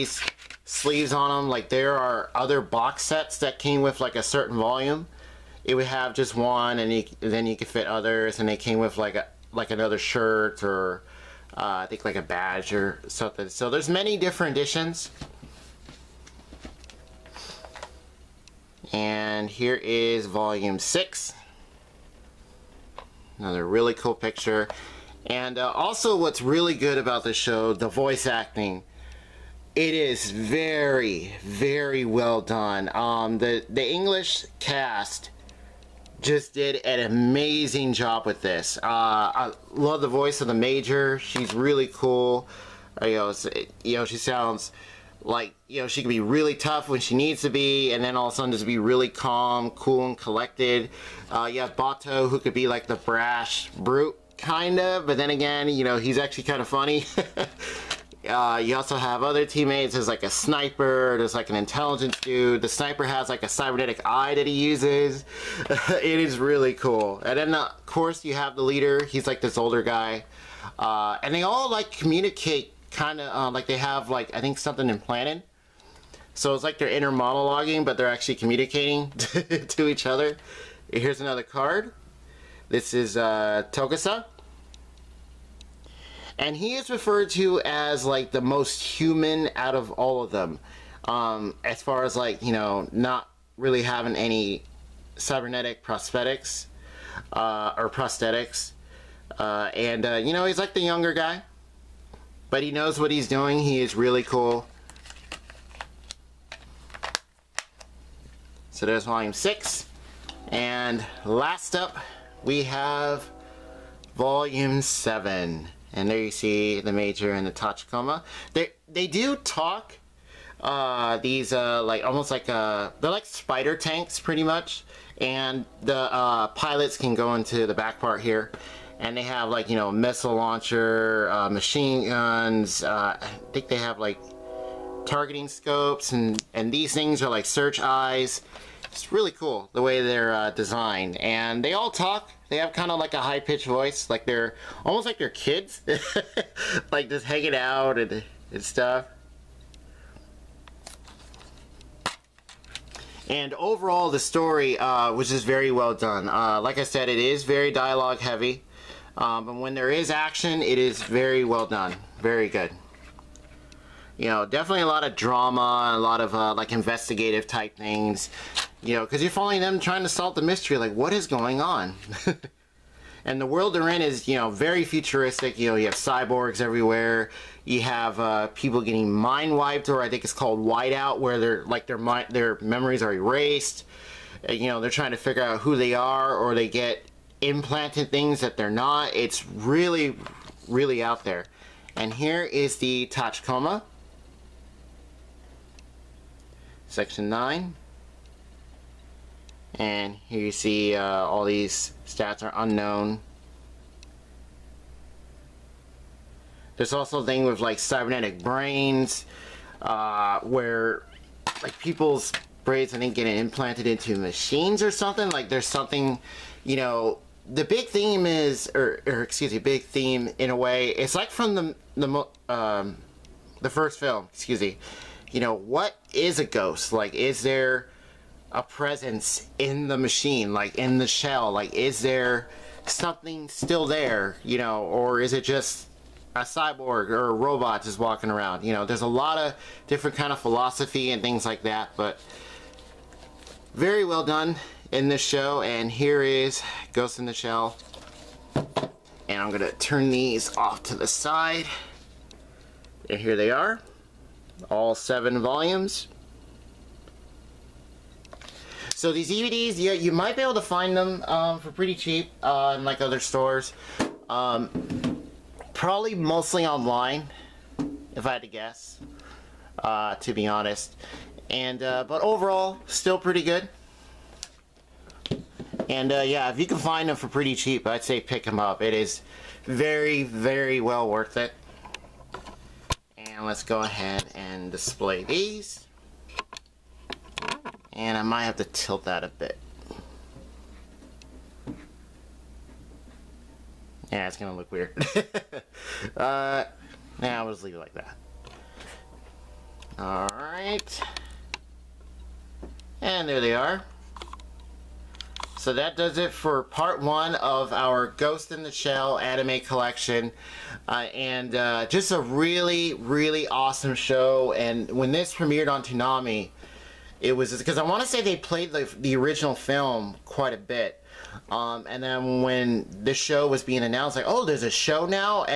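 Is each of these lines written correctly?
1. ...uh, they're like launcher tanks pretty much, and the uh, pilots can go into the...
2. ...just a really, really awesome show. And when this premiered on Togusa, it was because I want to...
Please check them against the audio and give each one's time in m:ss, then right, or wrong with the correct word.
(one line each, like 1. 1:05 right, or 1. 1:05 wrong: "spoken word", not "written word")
1. 2:02 wrong: "spider", not "launcher"
2. 5:11 wrong: "Toonami", not "Togusa".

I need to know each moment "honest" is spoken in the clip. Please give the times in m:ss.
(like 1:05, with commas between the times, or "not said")
4:30.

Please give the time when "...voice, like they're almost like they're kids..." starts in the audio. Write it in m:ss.
2:23.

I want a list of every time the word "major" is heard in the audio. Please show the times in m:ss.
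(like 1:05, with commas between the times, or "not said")
0:40, 1:56.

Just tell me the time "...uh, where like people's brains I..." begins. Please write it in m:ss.
3:29.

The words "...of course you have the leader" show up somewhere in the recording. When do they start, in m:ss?
1:07.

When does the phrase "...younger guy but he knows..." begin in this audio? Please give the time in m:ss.
1:40.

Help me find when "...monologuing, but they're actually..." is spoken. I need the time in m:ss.
1:17.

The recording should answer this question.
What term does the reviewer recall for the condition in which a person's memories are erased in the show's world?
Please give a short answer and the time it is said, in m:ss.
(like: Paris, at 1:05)
whiteout, at 3:00.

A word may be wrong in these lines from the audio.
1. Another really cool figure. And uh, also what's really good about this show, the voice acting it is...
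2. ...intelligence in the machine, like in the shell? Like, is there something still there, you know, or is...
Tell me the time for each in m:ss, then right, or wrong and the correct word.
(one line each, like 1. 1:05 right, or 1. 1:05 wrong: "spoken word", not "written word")
1. 0:23 wrong: "picture", not "figure"
2. 3:48 wrong: "presence", not "intelligence".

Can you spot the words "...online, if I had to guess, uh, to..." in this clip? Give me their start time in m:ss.
4:26.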